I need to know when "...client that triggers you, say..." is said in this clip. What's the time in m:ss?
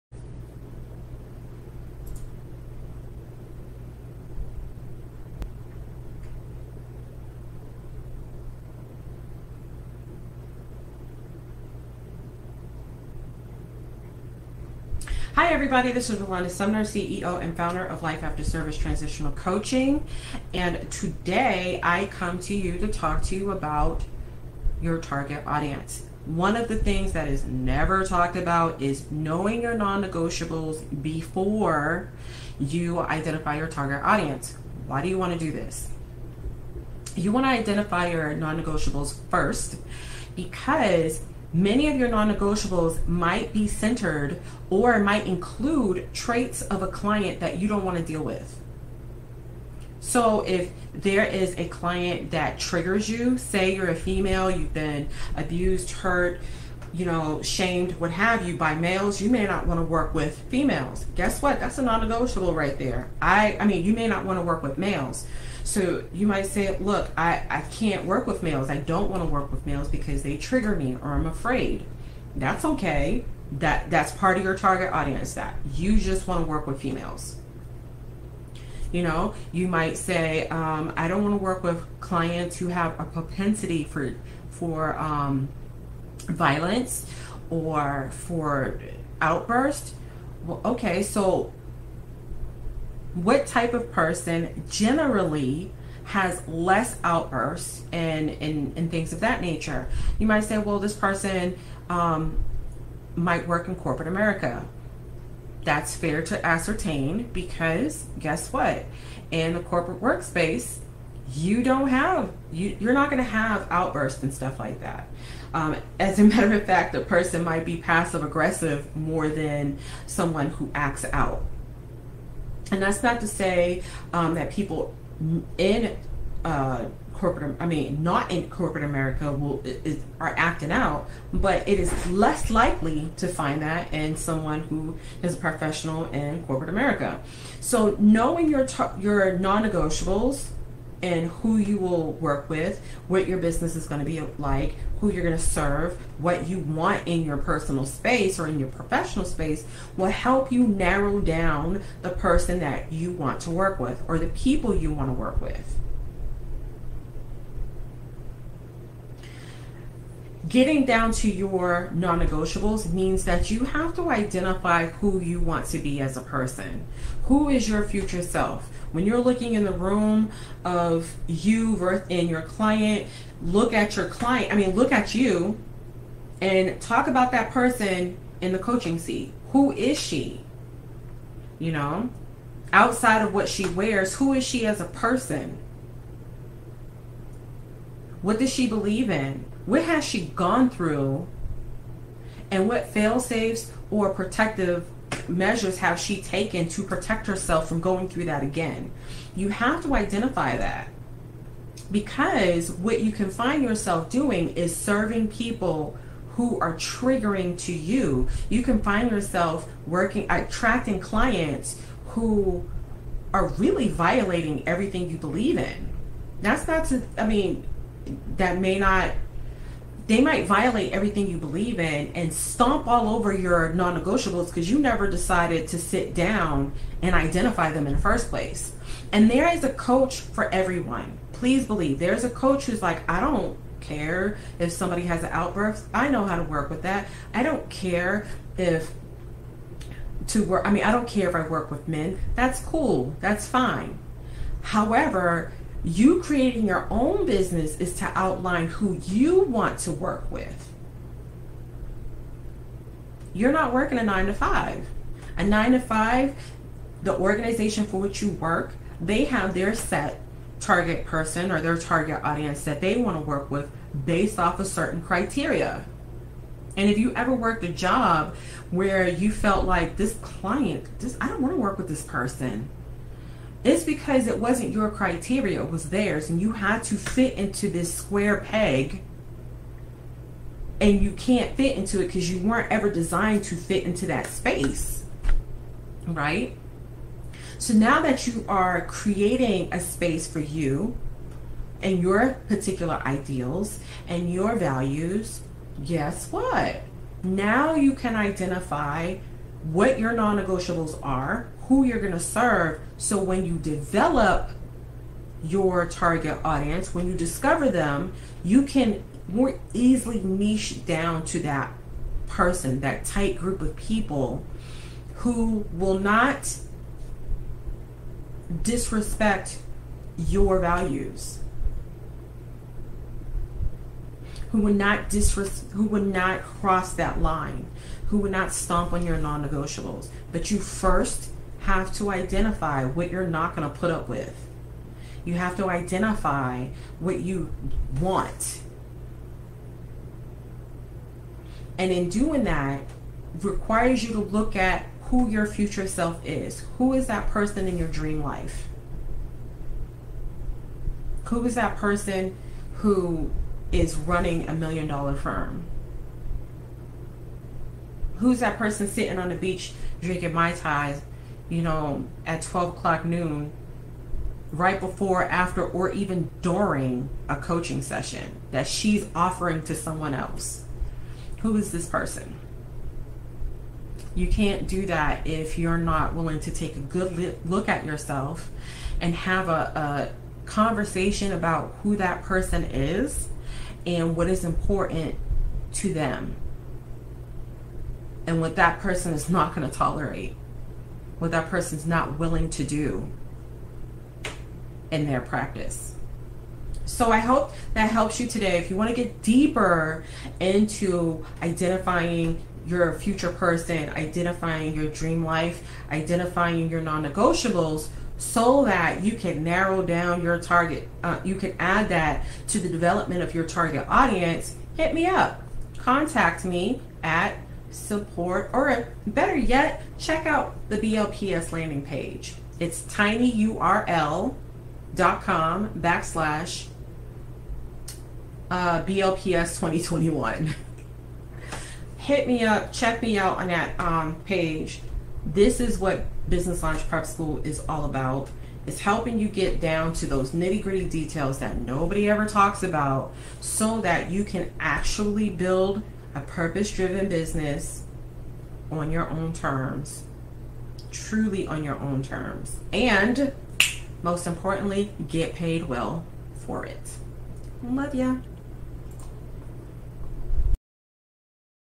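0:51.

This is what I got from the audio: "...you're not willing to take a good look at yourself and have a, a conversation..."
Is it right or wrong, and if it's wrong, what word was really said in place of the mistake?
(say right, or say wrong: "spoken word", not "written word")
right.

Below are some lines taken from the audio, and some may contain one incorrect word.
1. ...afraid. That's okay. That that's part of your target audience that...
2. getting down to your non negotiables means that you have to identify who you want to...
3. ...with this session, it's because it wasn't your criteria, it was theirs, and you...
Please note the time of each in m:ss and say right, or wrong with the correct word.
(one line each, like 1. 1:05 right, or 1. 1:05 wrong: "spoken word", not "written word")
1. 1:11 right
2. 2:40 right
3. 4:31 wrong: "person", not "session".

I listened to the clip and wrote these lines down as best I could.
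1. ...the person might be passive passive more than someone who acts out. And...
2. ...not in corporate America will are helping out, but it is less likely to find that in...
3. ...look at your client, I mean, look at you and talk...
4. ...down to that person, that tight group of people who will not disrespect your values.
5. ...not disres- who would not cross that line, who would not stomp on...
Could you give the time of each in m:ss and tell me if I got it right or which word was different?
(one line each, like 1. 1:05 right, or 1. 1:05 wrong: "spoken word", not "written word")
1. 1:56 wrong: "aggressive", not "passive"
2. 2:08 wrong: "acting", not "helping"
3. 2:53 right
4. 5:10 right
5. 5:24 right.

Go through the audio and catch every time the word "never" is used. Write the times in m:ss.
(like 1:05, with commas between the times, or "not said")
0:27, 3:44.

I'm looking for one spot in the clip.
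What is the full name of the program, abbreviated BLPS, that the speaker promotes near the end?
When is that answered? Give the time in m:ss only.
7:16.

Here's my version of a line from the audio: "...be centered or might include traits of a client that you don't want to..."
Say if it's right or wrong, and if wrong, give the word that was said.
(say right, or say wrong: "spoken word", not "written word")
right.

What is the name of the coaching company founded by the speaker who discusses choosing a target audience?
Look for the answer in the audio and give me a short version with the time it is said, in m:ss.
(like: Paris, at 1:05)
Life After Service Transitional Coaching, at 0:18.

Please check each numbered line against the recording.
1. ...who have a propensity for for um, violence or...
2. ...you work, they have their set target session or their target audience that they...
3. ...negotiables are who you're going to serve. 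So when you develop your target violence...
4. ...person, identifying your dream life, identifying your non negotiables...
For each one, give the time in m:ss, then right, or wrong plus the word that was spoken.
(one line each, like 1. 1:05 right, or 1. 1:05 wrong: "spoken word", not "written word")
1. 1:22 right
2. 4:18 wrong: "person", not "session"
3. 5:00 wrong: "audience", not "violence"
4. 6:43 right.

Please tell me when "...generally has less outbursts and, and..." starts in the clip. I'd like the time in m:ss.
1:34.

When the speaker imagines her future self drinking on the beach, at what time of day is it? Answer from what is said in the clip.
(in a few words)
12 o'clock noon.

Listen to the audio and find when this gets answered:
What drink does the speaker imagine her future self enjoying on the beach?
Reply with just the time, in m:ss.
6:00.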